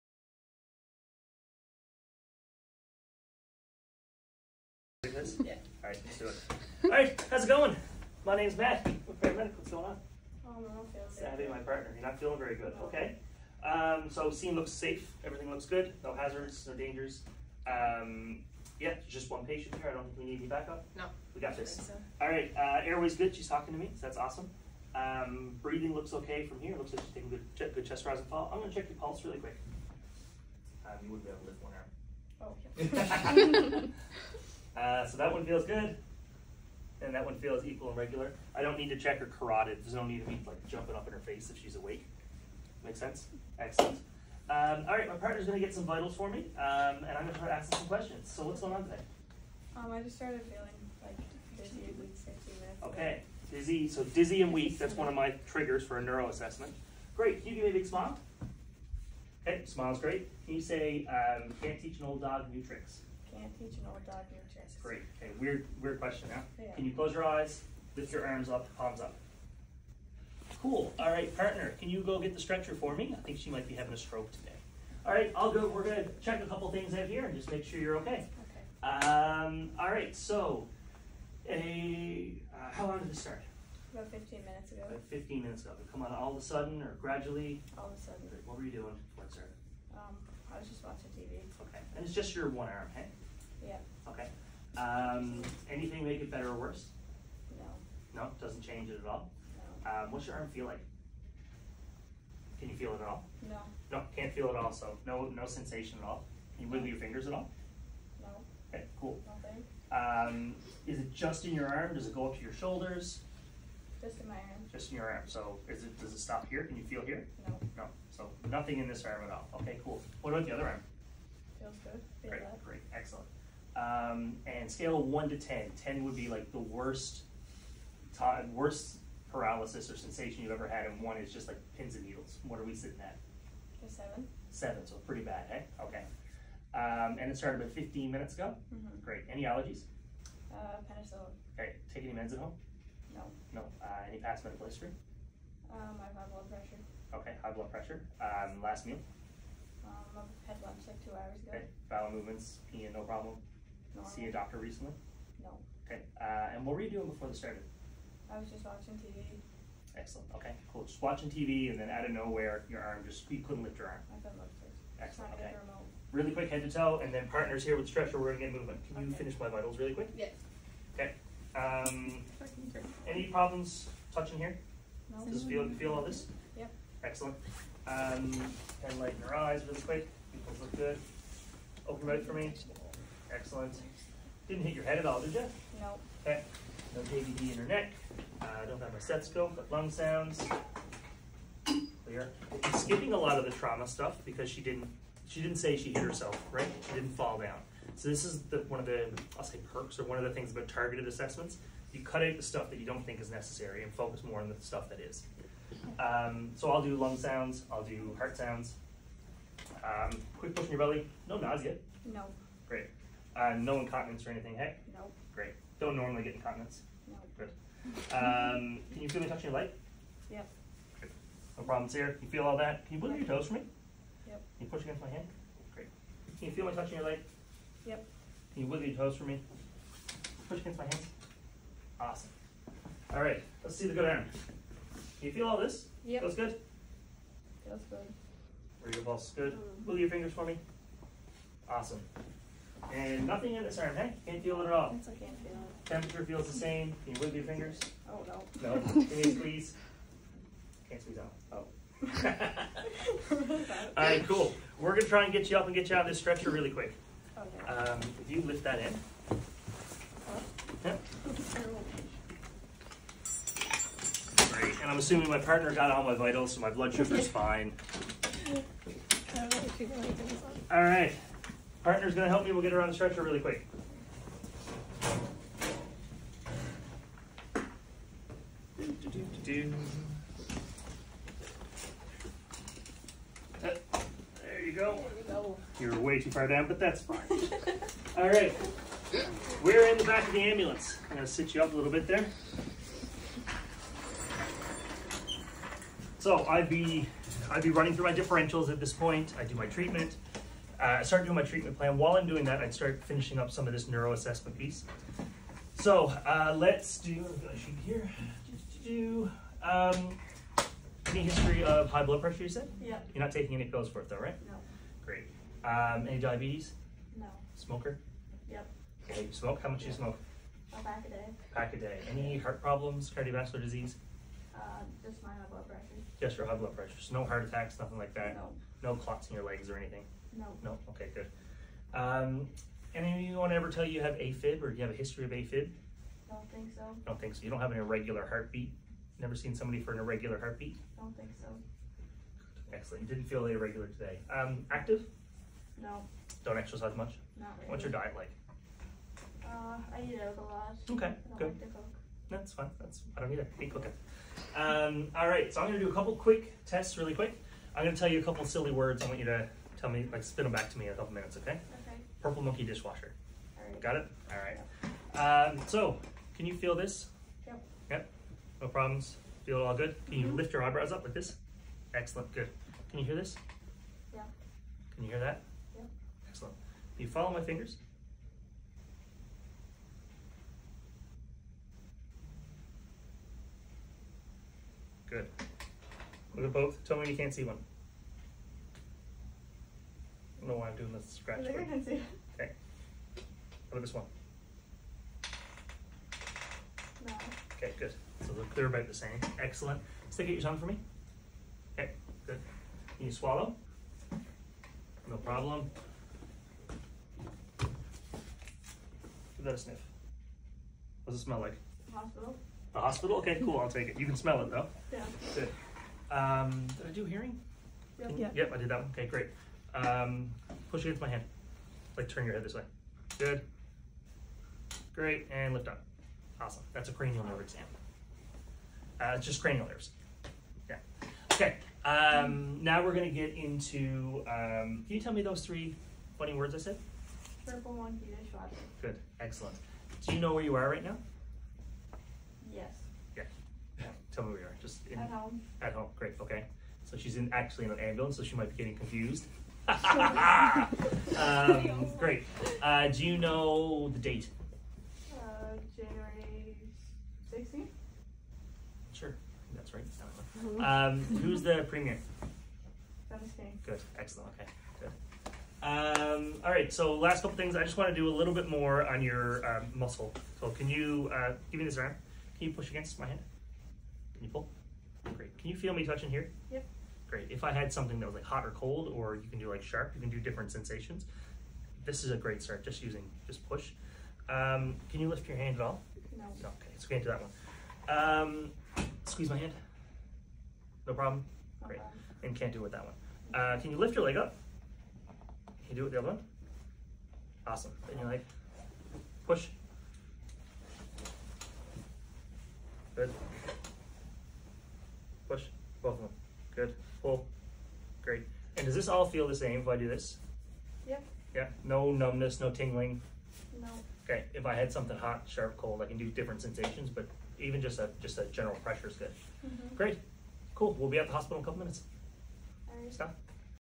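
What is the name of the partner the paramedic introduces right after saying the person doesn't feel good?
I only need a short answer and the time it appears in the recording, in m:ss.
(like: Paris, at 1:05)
Savvy, at 0:11.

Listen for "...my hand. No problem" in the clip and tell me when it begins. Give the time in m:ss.
8:09.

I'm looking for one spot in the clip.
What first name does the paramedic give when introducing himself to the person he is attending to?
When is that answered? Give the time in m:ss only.
0:08.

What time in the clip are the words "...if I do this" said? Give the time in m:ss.
8:29.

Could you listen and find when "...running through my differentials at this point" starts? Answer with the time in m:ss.
4:57.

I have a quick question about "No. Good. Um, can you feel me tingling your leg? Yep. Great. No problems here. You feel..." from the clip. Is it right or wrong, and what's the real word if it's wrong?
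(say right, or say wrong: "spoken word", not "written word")
wrong: "touching", not "tingling".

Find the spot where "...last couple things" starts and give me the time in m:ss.
7:46.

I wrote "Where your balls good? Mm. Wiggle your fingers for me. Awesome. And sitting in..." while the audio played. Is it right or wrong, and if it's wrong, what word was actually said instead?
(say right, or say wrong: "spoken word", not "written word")
wrong: "nothing", not "sitting".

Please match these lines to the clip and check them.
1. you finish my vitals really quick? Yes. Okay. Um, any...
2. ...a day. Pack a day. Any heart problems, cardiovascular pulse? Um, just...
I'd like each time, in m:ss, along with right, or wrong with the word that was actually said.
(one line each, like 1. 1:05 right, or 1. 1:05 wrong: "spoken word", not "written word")
1. 2:49 right
2. 5:21 wrong: "disease", not "pulse".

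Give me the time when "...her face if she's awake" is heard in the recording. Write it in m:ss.
0:41.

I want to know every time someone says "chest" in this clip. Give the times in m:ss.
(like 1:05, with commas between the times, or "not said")
0:27.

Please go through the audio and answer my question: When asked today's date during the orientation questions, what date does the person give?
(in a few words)
January 16th.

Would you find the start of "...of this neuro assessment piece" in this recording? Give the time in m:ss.
5:03.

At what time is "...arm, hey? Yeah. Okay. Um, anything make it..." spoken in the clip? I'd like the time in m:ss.
1:32.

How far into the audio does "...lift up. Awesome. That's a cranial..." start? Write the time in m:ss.
7:05.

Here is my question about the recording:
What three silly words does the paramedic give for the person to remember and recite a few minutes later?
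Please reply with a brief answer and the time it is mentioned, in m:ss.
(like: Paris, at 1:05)
Purple monkey dishwasher, at 6:02.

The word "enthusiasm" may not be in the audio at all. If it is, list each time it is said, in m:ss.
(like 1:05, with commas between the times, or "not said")
not said.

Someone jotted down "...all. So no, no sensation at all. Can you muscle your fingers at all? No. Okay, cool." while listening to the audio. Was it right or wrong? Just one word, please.
wrong.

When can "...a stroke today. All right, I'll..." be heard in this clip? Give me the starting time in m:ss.
1:13.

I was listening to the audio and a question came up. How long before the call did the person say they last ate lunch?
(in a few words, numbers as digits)
2 hours ago.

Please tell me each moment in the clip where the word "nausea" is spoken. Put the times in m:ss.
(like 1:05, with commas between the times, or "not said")
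3:31.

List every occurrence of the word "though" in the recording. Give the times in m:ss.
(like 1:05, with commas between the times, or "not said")
5:14, 6:54.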